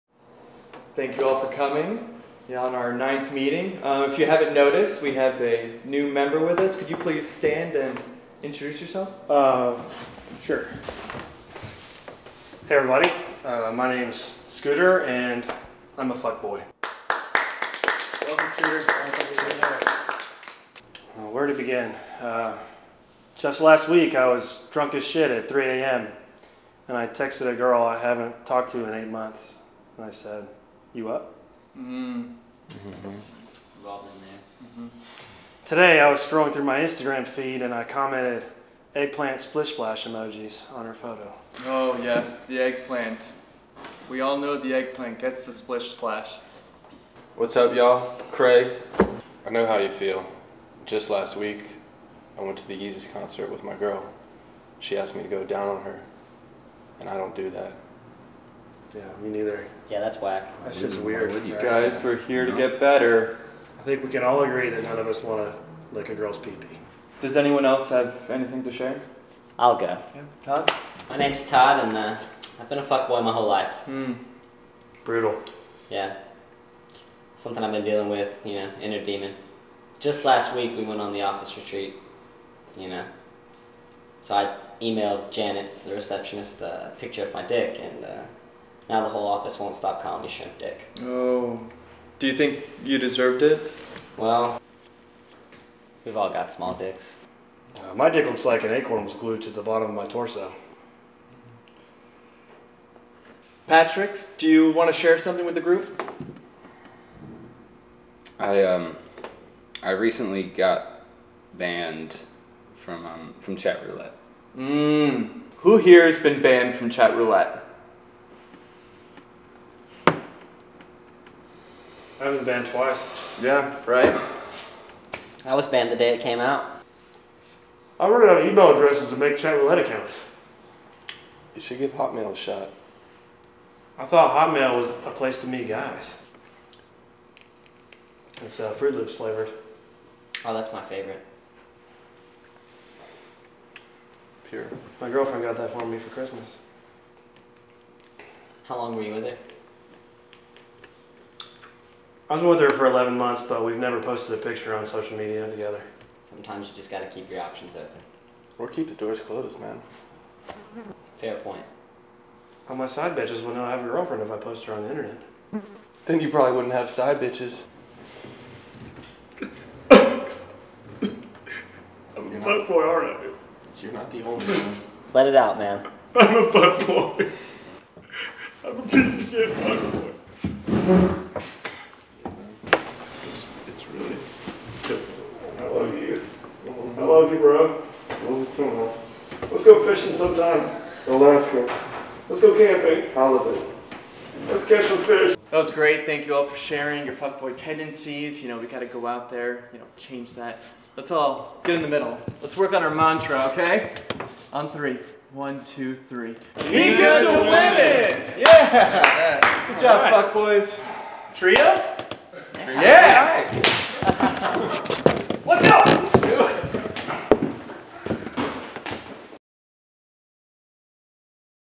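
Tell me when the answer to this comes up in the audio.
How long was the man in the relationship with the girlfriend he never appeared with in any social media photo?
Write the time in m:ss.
2:32.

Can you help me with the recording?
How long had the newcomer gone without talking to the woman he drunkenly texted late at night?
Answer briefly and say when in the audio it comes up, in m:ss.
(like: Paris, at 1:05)
8 months, at 0:28.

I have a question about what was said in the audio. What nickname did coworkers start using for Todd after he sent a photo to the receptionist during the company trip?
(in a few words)
Shrimp Dick.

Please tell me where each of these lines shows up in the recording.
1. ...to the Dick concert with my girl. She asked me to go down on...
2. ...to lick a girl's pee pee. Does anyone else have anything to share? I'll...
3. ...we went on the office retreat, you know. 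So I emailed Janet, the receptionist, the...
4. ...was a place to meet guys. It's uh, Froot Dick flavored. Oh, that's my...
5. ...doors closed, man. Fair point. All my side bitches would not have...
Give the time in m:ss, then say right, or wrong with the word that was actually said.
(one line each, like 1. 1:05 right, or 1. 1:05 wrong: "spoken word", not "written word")
1. 0:52 wrong: "Yeezus", not "Dick"
2. 1:05 right
3. 1:20 right
4. 2:14 wrong: "Loops", not "Dick"
5. 2:38 right.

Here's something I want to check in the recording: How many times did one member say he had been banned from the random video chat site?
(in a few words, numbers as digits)
2.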